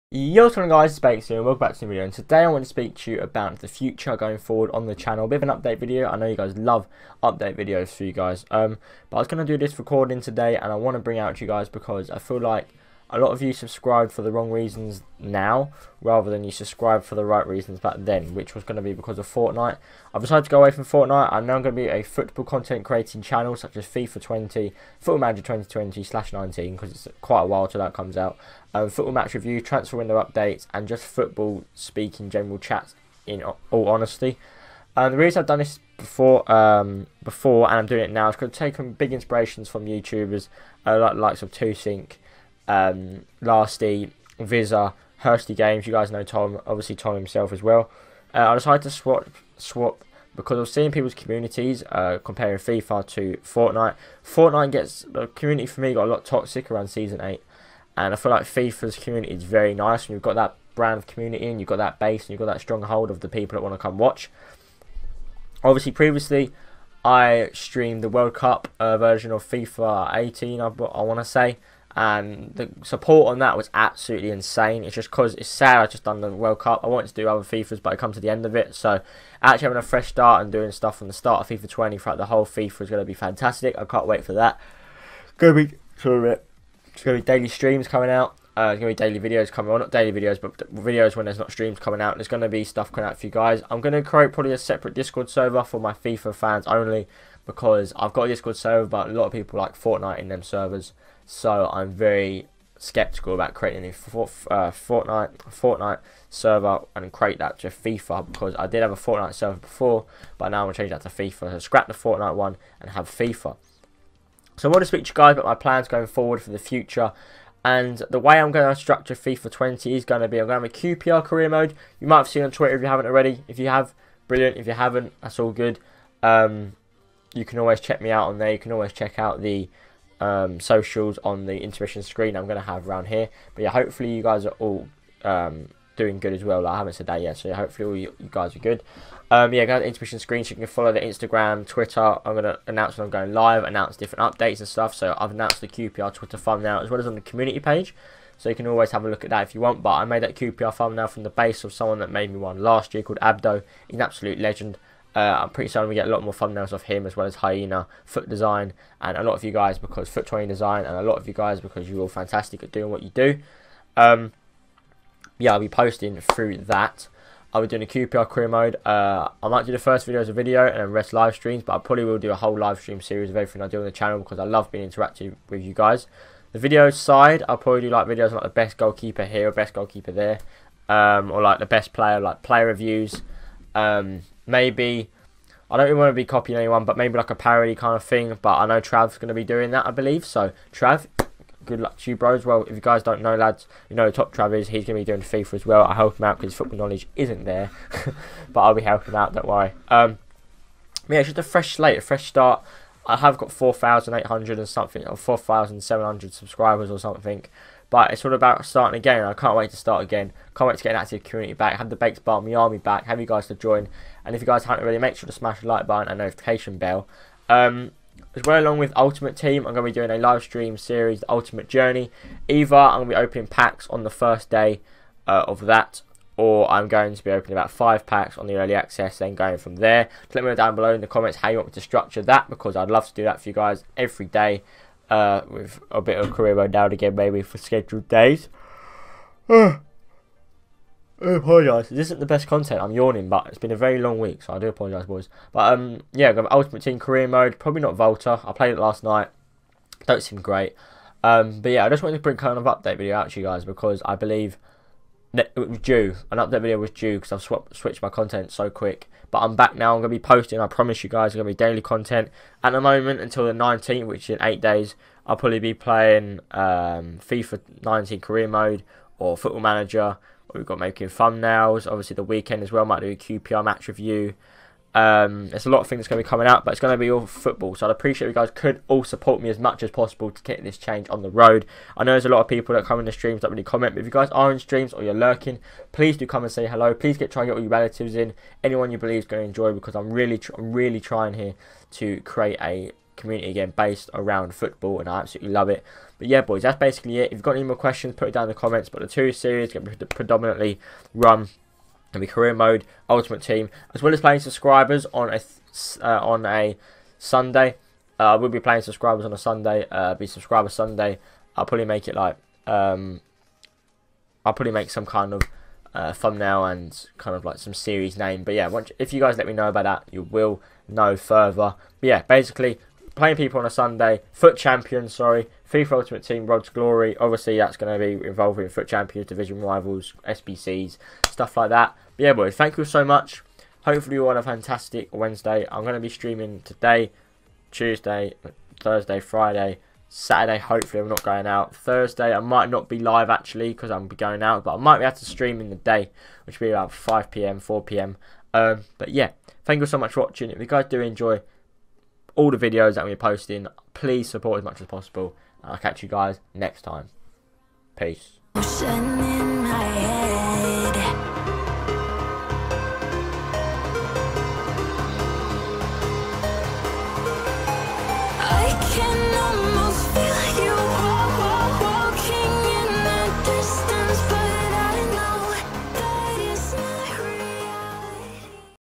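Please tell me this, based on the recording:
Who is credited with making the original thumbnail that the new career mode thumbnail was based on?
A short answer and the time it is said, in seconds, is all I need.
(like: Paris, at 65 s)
Abdo, at 153 s.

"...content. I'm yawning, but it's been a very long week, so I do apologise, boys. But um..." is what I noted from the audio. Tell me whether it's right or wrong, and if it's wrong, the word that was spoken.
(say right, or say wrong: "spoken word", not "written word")
right.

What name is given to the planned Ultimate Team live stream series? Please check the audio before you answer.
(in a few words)
the Ultimate Journey.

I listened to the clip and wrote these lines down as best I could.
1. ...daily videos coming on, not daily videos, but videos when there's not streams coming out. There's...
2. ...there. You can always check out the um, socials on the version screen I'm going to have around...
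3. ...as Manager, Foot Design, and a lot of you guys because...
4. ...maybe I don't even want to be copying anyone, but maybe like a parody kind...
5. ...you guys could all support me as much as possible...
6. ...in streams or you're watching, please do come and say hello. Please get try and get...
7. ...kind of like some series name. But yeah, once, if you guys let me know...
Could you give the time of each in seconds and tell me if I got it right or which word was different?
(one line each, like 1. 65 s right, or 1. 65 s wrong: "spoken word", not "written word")
1. 89 s right
2. 128 s wrong: "intermission", not "version"
3. 157 s wrong: "Hyena", not "Manager"
4. 184 s right
5. 278 s right
6. 284 s wrong: "lurking", not "watching"
7. 317 s right.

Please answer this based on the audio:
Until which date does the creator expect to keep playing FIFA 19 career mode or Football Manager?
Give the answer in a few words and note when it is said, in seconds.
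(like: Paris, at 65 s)
the 19th, at 263 s.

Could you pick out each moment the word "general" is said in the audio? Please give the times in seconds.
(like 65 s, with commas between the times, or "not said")
32 s.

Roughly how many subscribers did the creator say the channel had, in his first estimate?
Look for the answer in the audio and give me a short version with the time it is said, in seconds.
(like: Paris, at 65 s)
4,800, at 203 s.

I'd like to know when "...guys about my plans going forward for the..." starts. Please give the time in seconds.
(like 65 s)
115 s.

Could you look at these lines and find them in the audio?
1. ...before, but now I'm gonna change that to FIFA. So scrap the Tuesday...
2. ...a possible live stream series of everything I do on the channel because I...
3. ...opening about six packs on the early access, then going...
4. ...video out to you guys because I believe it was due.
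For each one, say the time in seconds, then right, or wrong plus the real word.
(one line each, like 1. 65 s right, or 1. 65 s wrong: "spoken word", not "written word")
1. 109 s wrong: "Fortnite", not "Tuesday"
2. 172 s wrong: "whole", not "possible"
3. 227 s wrong: "five", not "six"
4. 252 s right.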